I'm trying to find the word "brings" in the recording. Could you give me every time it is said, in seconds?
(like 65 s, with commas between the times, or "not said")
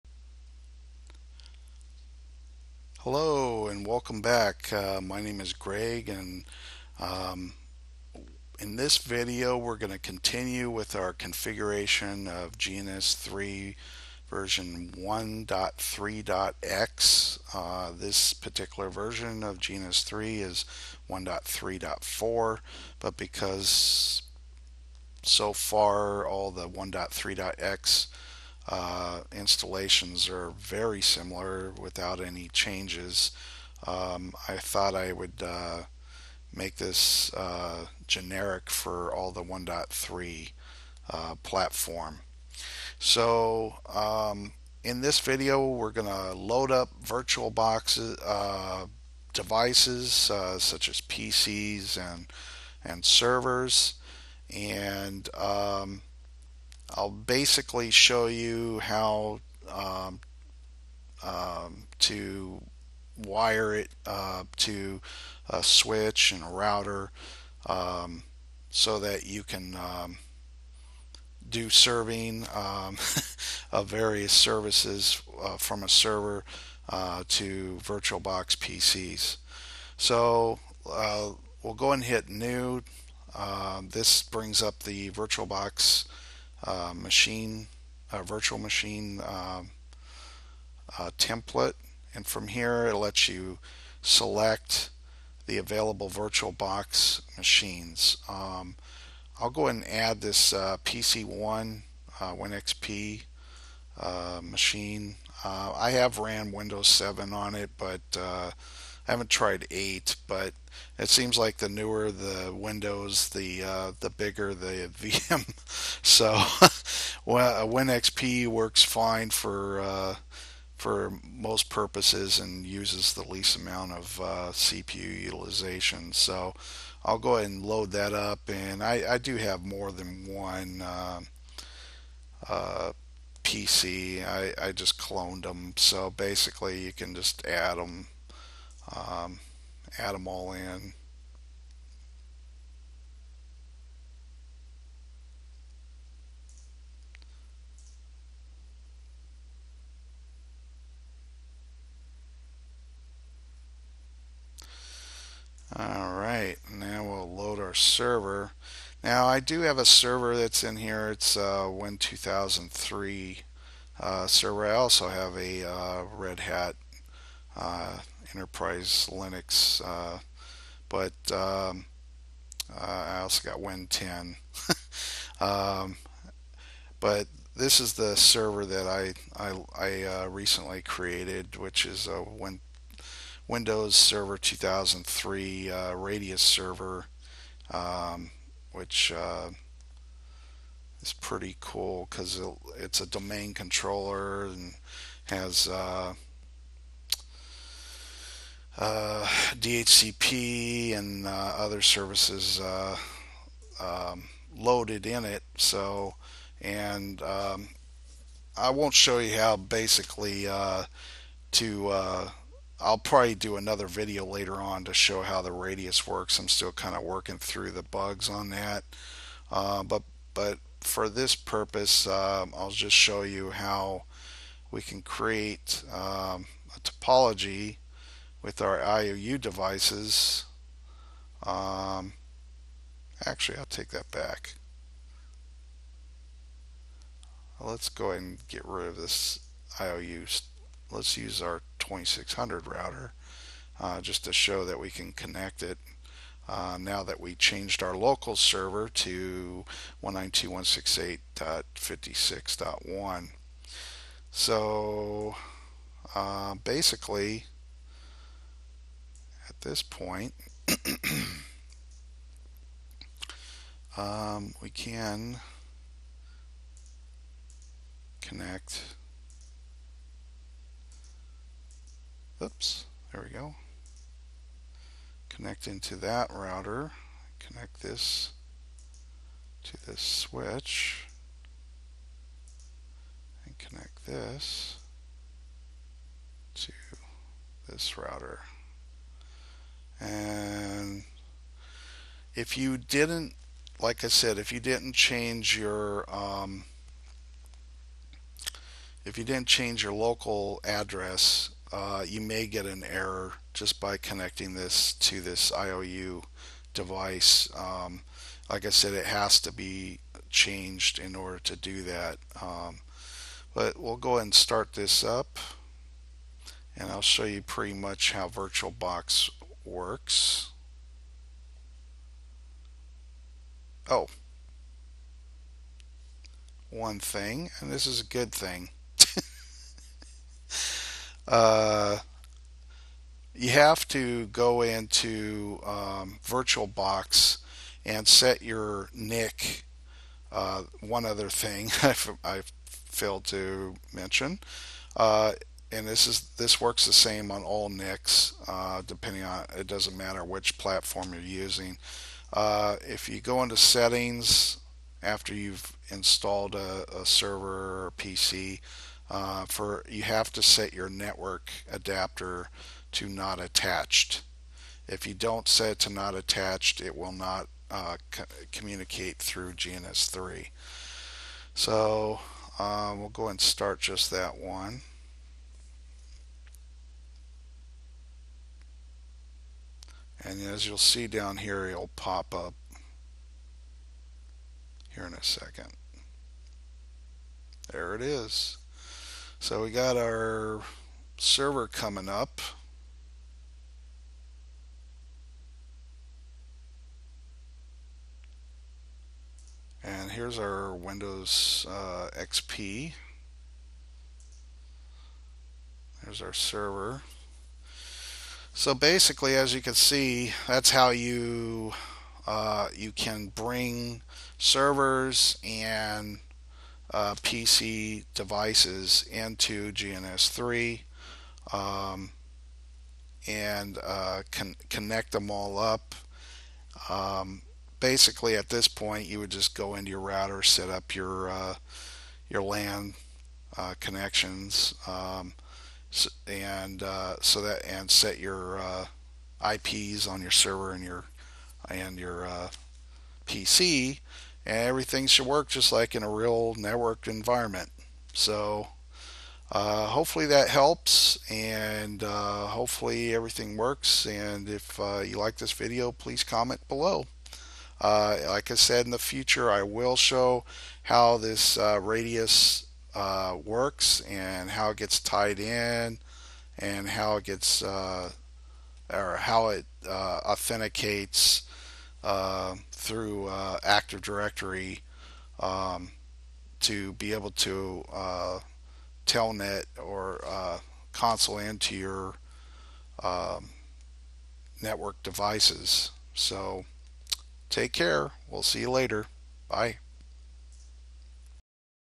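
84 s, 413 s.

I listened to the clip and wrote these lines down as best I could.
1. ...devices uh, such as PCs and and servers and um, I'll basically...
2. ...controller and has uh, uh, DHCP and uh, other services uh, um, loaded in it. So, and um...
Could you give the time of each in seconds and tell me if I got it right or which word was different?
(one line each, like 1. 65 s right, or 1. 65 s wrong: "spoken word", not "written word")
1. 49 s right
2. 193 s right.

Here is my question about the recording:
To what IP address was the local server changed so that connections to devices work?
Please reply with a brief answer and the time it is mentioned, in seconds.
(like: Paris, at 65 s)
192.168.56.1, at 250 s.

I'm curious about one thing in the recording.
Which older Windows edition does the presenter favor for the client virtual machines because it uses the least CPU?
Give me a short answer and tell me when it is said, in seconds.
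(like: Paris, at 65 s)
Win XP, at 117 s.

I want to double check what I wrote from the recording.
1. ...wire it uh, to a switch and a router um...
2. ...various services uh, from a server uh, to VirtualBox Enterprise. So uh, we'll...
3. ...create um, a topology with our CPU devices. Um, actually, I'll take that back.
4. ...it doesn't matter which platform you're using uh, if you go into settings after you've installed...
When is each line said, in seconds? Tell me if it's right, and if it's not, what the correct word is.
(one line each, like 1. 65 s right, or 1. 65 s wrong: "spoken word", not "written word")
1. 63 s right
2. 73 s wrong: "PCs", not "Enterprise"
3. 225 s wrong: "IOU", not "CPU"
4. 349 s right.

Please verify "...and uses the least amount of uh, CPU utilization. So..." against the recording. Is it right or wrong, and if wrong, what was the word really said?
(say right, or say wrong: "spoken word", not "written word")
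right.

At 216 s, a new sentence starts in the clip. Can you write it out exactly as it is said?
I'm still kind of working through the bugs on that.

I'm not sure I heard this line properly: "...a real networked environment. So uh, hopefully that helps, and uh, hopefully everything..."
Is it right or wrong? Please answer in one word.
right.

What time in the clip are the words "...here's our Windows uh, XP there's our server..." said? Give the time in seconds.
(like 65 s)
400 s.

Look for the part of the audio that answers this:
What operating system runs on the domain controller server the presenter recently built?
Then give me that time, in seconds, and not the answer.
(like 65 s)
161 s.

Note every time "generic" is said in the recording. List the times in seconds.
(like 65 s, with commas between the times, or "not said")
38 s.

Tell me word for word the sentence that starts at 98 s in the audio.
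Um, I'll go ahead and add this uh, PC1 uh, WinXP uh, machine.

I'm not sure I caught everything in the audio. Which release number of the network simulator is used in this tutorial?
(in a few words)
1.3.4.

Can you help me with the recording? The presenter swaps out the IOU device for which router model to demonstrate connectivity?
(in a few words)
2600.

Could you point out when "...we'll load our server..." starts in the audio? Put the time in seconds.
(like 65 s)
157 s.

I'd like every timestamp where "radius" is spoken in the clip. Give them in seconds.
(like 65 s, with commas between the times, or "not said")
185 s, 215 s, 461 s.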